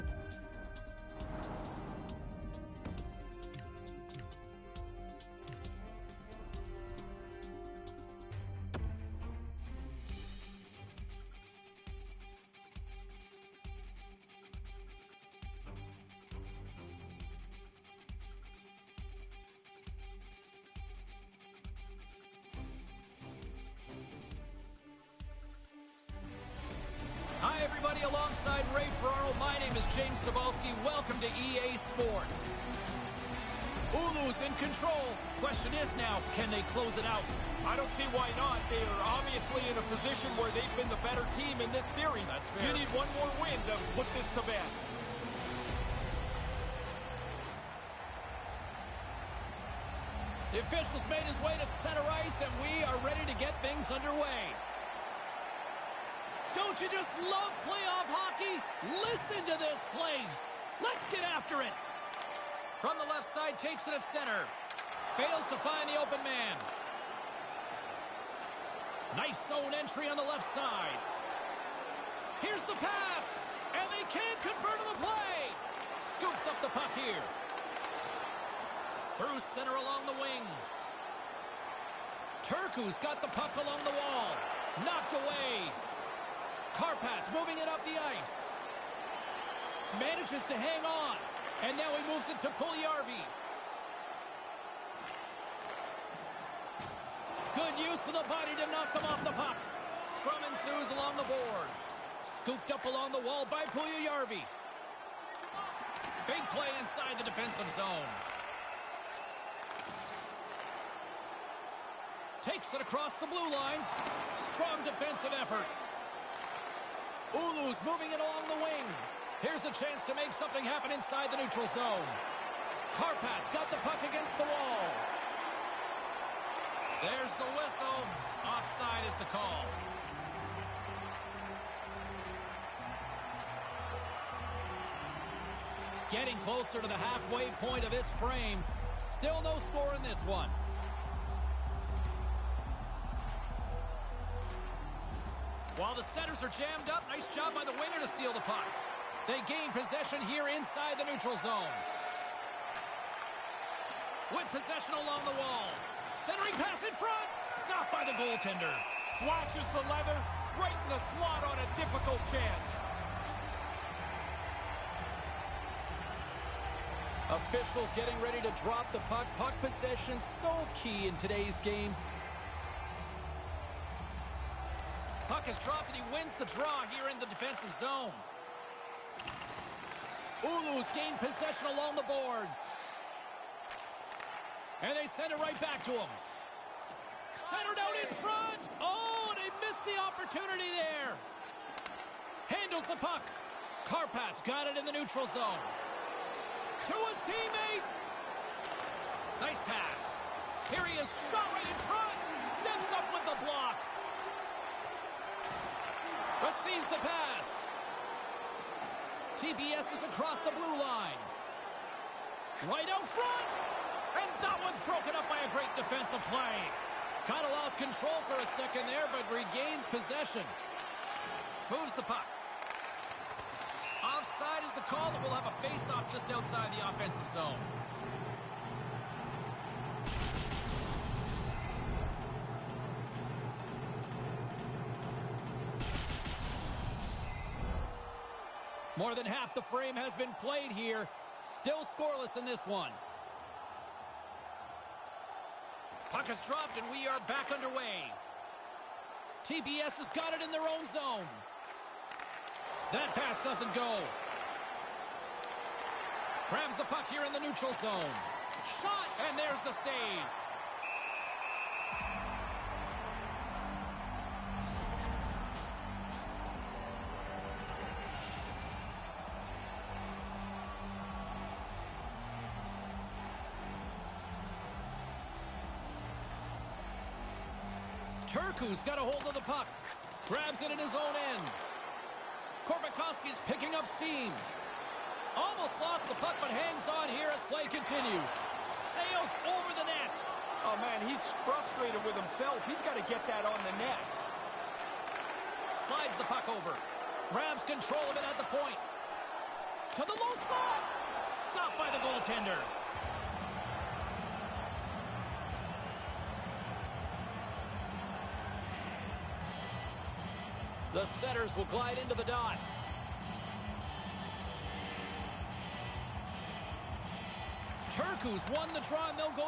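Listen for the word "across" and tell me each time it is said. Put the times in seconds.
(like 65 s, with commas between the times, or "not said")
112 s, 210 s.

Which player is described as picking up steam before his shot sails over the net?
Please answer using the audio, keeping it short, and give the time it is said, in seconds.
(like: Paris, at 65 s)
Korbakovsky, at 282 s.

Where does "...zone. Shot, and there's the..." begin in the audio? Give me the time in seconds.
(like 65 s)
257 s.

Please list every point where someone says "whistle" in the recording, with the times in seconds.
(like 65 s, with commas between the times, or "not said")
127 s.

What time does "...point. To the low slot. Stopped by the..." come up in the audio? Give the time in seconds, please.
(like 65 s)
298 s.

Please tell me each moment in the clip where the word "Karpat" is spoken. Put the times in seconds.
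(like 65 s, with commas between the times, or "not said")
86 s, 122 s, 193 s.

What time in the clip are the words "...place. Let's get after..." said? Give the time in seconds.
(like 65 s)
59 s.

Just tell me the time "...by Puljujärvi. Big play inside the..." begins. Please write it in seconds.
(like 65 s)
103 s.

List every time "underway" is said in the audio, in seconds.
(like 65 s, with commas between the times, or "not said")
53 s, 247 s.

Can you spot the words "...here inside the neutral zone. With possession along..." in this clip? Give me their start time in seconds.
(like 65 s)
150 s.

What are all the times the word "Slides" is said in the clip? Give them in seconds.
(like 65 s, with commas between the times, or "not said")
295 s.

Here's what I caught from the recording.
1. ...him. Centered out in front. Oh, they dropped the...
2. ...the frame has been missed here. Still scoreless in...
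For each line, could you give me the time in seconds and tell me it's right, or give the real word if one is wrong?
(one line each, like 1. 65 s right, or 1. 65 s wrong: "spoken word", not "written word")
1. 185 s wrong: "missed", not "dropped"
2. 239 s wrong: "played", not "missed".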